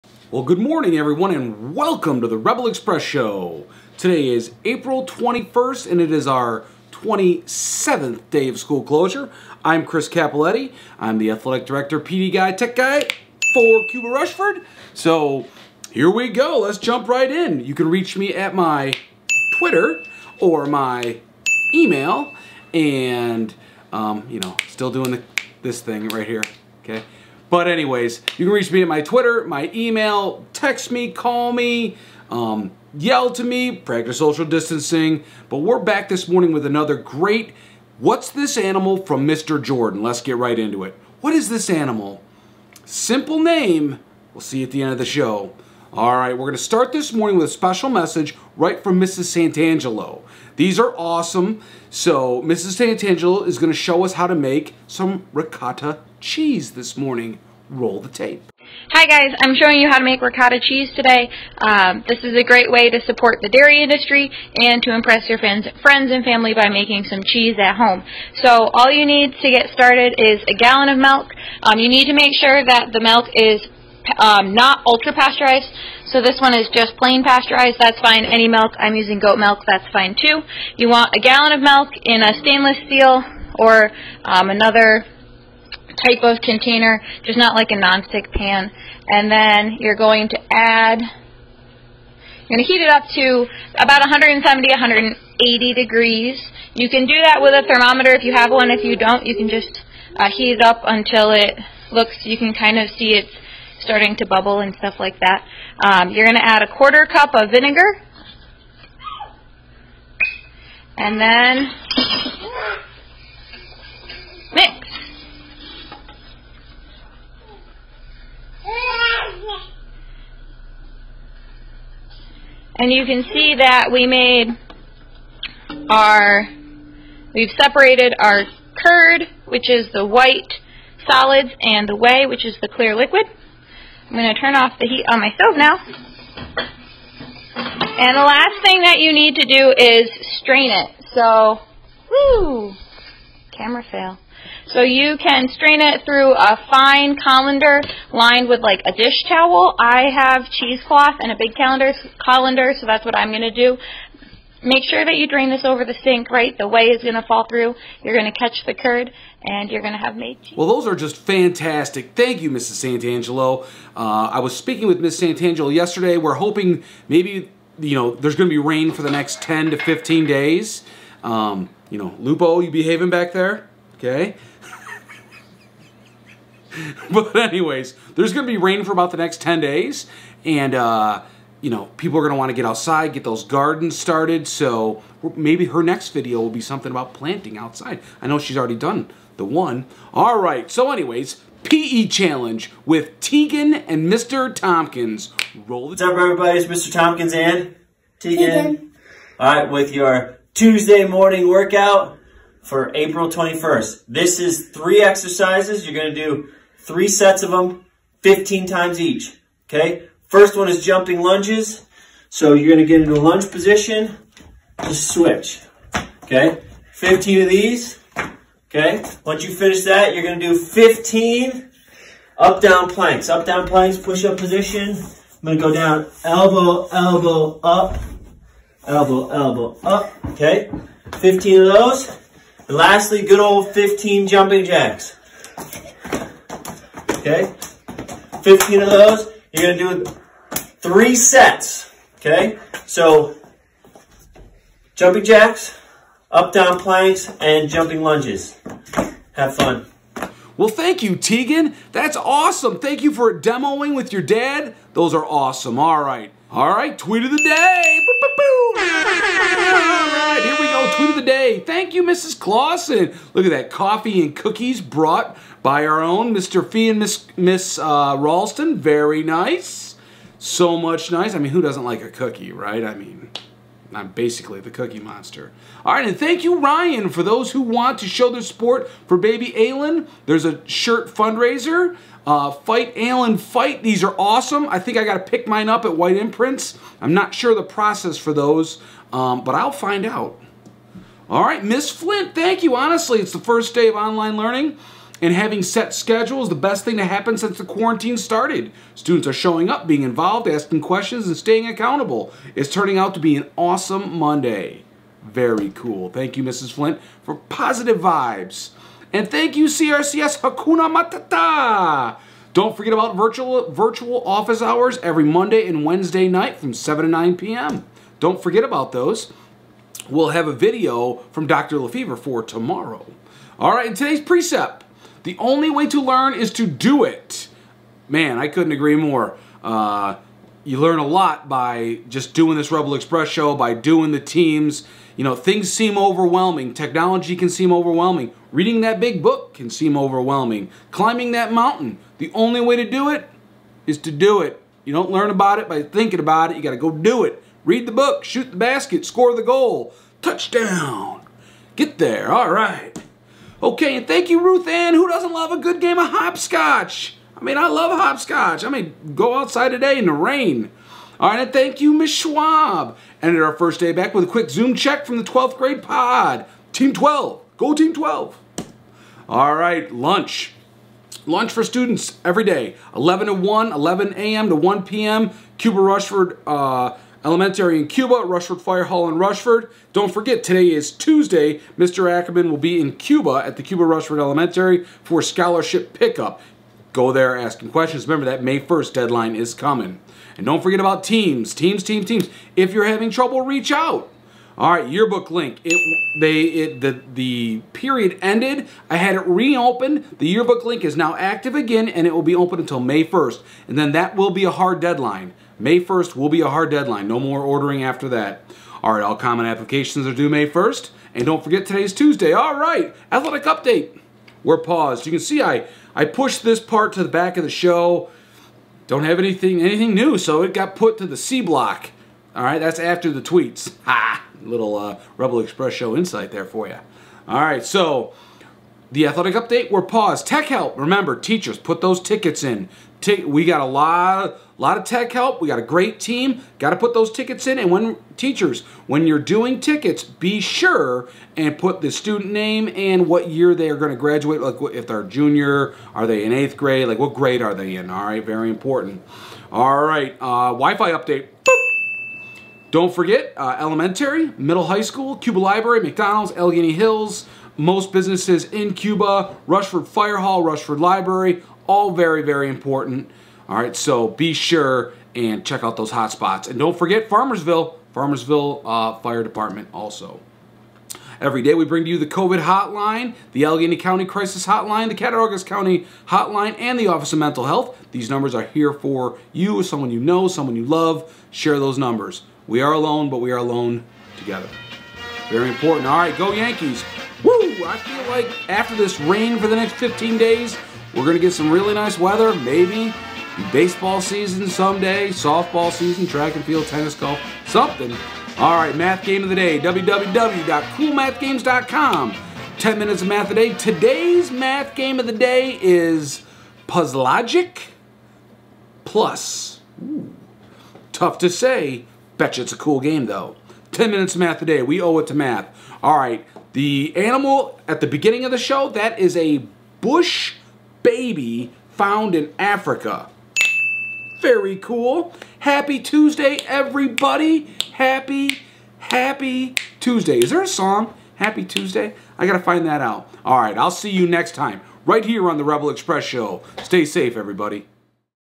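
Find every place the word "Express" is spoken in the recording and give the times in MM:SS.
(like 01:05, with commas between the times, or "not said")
00:02, 05:32, 07:05, 08:55.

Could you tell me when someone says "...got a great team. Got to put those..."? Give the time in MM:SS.
07:15.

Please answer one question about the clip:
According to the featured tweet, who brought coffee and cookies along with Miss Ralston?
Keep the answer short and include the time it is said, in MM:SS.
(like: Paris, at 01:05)
Mr. Fee, at 04:26.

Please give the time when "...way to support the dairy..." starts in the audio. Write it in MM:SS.
01:02.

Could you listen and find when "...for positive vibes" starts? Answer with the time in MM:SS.
05:07.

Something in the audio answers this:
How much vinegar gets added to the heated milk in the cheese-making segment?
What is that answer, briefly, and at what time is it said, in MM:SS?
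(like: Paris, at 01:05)
A quarter cup, at 01:46.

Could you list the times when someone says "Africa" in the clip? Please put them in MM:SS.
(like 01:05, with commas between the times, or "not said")
08:42.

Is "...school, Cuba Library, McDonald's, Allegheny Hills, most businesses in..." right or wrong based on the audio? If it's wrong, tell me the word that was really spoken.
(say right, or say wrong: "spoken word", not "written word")
right.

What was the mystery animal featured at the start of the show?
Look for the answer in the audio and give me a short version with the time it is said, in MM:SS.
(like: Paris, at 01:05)
Bush baby, at 08:39.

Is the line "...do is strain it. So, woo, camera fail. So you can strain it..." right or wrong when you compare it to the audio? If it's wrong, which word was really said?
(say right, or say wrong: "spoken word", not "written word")
right.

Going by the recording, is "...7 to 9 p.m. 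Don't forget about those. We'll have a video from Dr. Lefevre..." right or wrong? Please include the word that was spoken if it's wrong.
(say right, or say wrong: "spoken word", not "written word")
right.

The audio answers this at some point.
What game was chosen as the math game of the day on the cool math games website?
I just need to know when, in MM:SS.
08:26.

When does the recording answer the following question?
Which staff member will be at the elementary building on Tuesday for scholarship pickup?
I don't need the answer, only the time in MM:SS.
06:21.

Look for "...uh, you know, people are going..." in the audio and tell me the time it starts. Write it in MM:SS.
03:00.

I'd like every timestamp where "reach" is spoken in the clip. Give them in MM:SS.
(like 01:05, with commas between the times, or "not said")
00:17, 00:28, 06:33.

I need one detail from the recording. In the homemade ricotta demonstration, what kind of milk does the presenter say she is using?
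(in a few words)
Goat milk.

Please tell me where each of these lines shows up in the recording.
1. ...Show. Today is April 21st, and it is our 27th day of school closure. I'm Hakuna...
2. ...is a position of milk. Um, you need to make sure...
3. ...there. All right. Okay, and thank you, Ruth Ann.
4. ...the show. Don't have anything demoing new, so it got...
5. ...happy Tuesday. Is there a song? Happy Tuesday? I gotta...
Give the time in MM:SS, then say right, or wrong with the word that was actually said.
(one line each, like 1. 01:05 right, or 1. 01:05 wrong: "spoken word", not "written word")
1. 00:03 wrong: "Chris", not "Hakuna"
2. 01:10 wrong: "gallon", not "position"
3. 05:51 right
4. 06:57 wrong: "anything", not "demoing"
5. 08:48 right.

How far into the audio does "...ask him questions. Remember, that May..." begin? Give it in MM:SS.
06:27.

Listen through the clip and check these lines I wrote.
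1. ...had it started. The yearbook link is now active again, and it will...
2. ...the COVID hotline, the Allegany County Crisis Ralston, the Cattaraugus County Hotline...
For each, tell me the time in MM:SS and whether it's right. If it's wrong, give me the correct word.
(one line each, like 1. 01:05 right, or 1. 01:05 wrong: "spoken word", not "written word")
1. 06:38 wrong: "reopened", not "started"
2. 07:51 wrong: "Hotline", not "Ralston".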